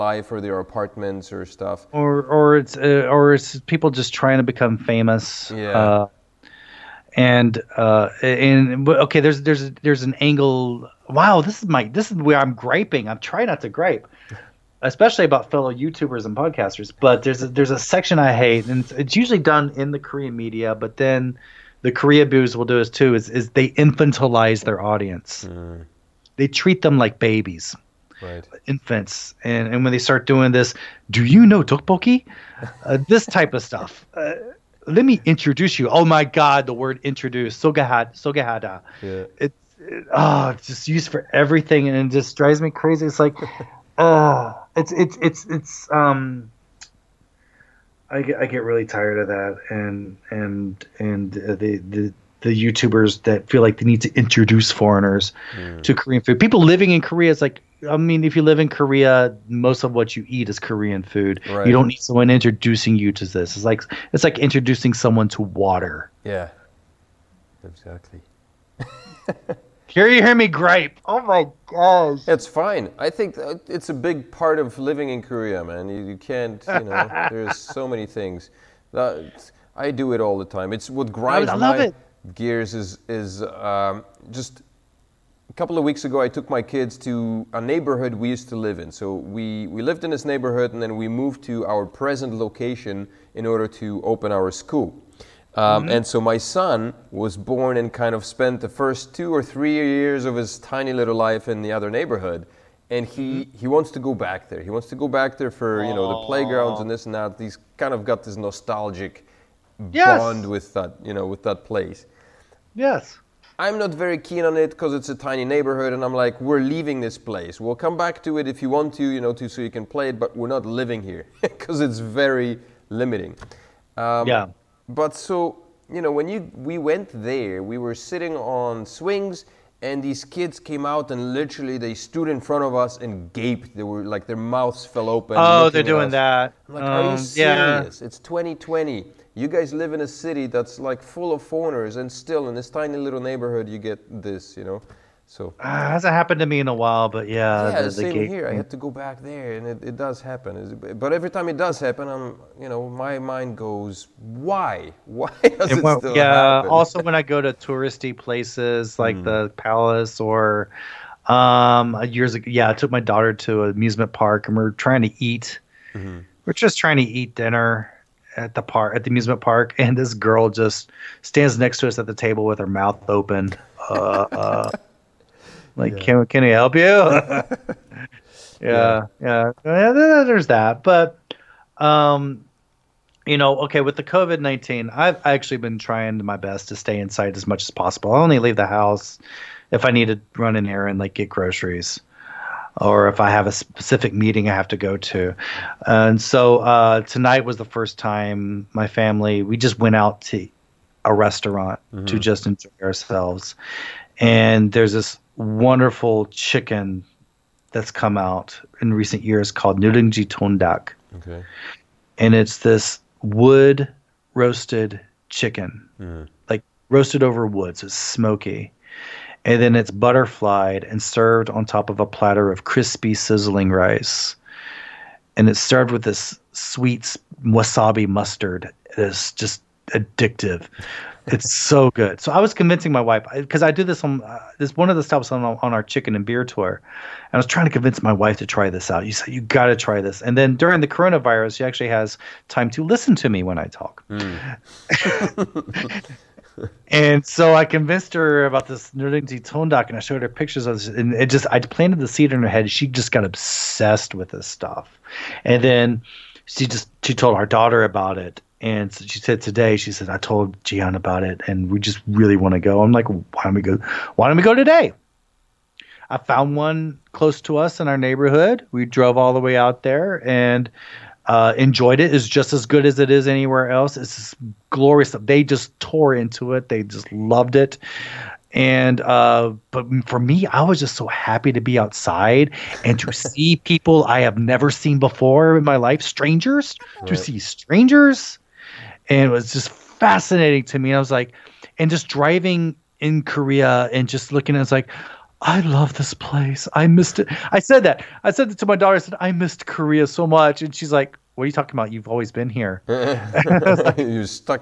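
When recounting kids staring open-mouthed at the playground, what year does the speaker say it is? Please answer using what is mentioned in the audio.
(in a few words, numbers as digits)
2020.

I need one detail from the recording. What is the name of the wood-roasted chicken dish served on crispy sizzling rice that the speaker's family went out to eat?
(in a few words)
Nurungji Tongdak.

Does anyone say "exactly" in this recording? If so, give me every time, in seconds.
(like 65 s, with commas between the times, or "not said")
67 s.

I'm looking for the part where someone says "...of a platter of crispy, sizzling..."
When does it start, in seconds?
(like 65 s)
221 s.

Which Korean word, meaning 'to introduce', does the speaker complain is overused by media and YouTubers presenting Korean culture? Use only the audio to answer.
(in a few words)
sogahada.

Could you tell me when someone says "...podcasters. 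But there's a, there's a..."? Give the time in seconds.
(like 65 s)
16 s.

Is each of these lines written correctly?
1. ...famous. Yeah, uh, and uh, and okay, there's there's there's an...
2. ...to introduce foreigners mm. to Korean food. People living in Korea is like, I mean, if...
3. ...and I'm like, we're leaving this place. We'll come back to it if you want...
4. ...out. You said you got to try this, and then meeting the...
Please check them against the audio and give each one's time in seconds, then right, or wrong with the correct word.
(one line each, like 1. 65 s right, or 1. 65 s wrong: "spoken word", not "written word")
1. 4 s right
2. 54 s right
3. 115 s right
4. 238 s wrong: "during", not "meeting".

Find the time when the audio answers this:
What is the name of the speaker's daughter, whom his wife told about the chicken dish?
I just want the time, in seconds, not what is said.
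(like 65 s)
260 s.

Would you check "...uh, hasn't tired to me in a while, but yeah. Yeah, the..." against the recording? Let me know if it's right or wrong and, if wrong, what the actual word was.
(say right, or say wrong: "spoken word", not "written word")
wrong: "happened", not "tired".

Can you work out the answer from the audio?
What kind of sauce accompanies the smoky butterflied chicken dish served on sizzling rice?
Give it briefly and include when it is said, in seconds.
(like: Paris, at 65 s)
sweet wasabi mustard, at 226 s.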